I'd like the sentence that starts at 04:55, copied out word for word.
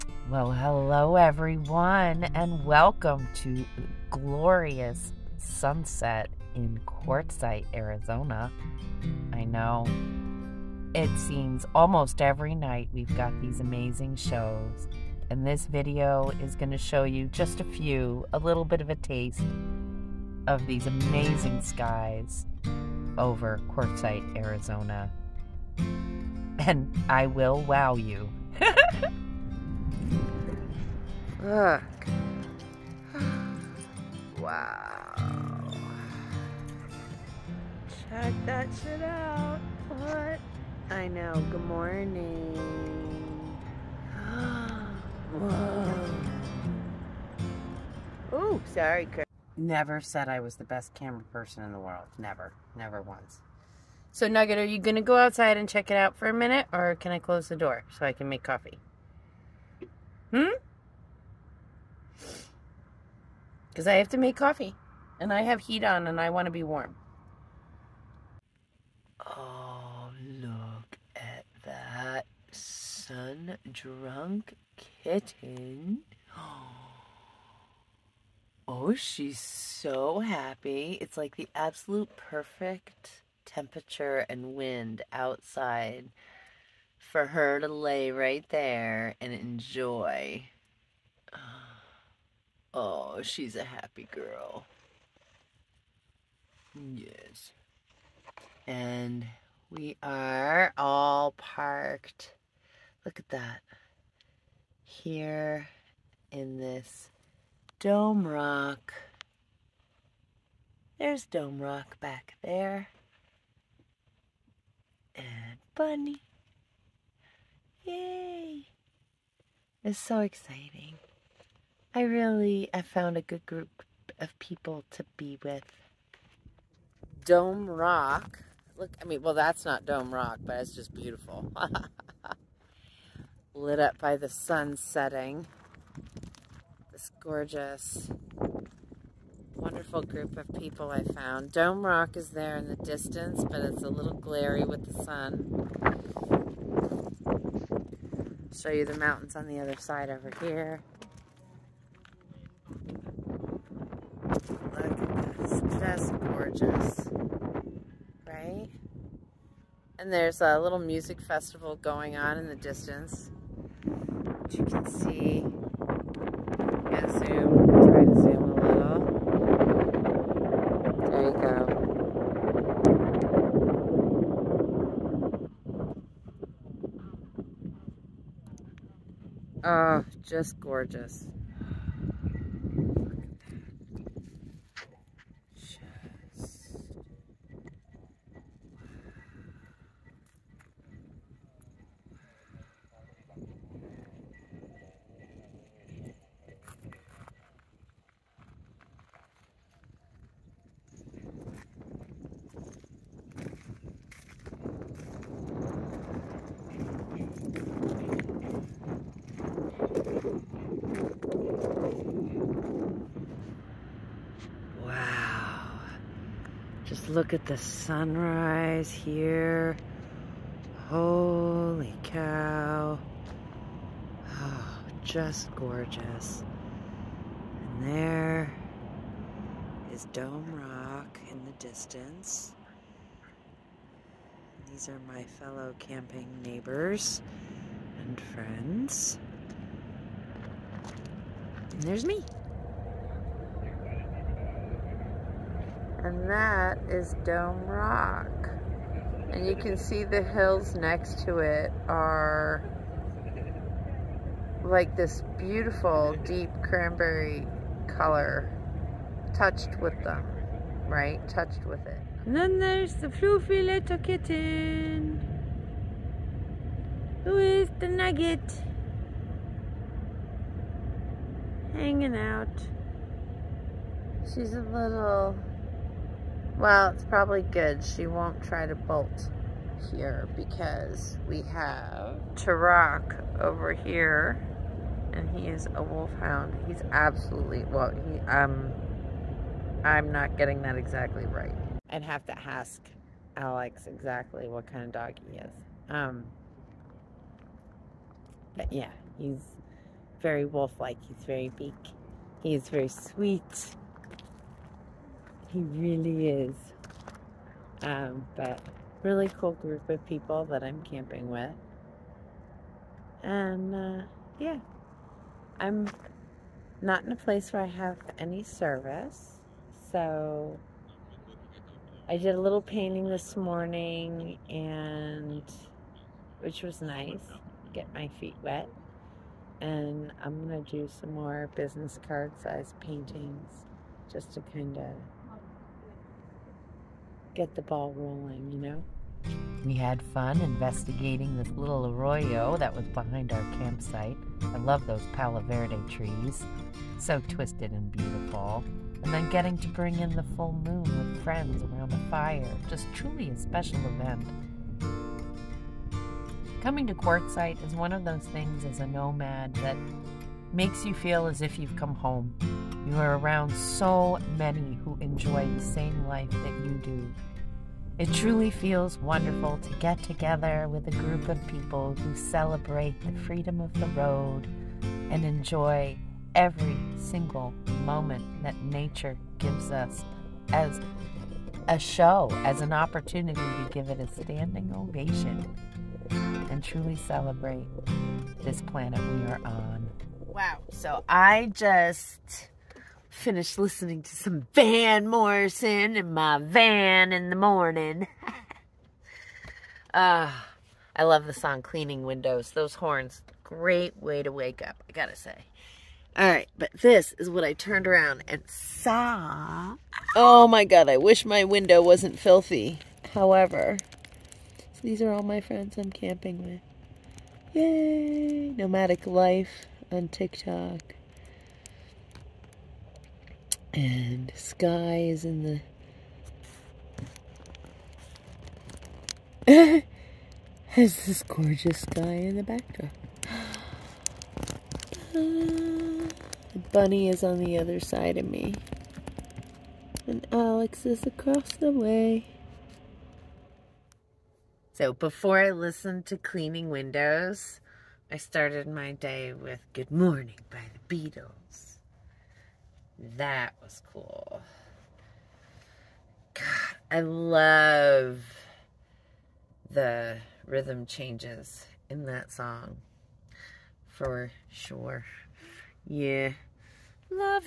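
Um, but yeah, he's very wolf-like.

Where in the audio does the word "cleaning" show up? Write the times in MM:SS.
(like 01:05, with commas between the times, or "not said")
06:41, 07:26.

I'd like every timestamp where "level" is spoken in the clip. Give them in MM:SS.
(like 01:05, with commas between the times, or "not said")
not said.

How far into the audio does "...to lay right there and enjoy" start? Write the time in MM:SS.
01:27.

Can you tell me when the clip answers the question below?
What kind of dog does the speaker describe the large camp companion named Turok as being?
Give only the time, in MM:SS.
04:45.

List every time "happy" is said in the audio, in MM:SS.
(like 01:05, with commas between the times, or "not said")
01:20, 01:33.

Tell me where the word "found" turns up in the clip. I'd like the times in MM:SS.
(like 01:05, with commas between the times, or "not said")
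02:02, 02:21.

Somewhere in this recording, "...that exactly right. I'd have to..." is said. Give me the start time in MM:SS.
04:50.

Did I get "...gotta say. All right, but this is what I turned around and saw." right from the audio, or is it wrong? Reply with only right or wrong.
right.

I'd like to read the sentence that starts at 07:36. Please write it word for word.
God, I love the rhythm changes in that song.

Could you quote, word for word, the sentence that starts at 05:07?
Um, but really cool group of people that I'm camping with.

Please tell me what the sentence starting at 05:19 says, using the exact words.
So I did a little painting this morning and which was nice.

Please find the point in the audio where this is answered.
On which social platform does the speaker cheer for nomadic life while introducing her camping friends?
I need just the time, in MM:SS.
07:00.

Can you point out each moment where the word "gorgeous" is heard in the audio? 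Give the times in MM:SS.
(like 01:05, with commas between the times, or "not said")
02:17, 02:36, 03:00, 03:45, 07:11.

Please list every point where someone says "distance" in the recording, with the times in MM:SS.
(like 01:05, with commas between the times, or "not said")
02:22, 02:42, 03:51.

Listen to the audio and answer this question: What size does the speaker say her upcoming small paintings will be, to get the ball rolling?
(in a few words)
business card size.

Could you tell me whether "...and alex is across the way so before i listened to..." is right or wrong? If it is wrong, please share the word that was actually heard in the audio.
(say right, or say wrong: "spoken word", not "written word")
right.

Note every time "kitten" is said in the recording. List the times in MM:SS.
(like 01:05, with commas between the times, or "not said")
01:14, 04:23.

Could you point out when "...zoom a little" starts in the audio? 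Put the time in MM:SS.
02:48.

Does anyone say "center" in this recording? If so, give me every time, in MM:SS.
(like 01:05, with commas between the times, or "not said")
not said.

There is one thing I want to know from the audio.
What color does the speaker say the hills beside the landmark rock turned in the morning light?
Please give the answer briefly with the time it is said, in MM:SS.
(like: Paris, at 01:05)
deep cranberry, at 04:16.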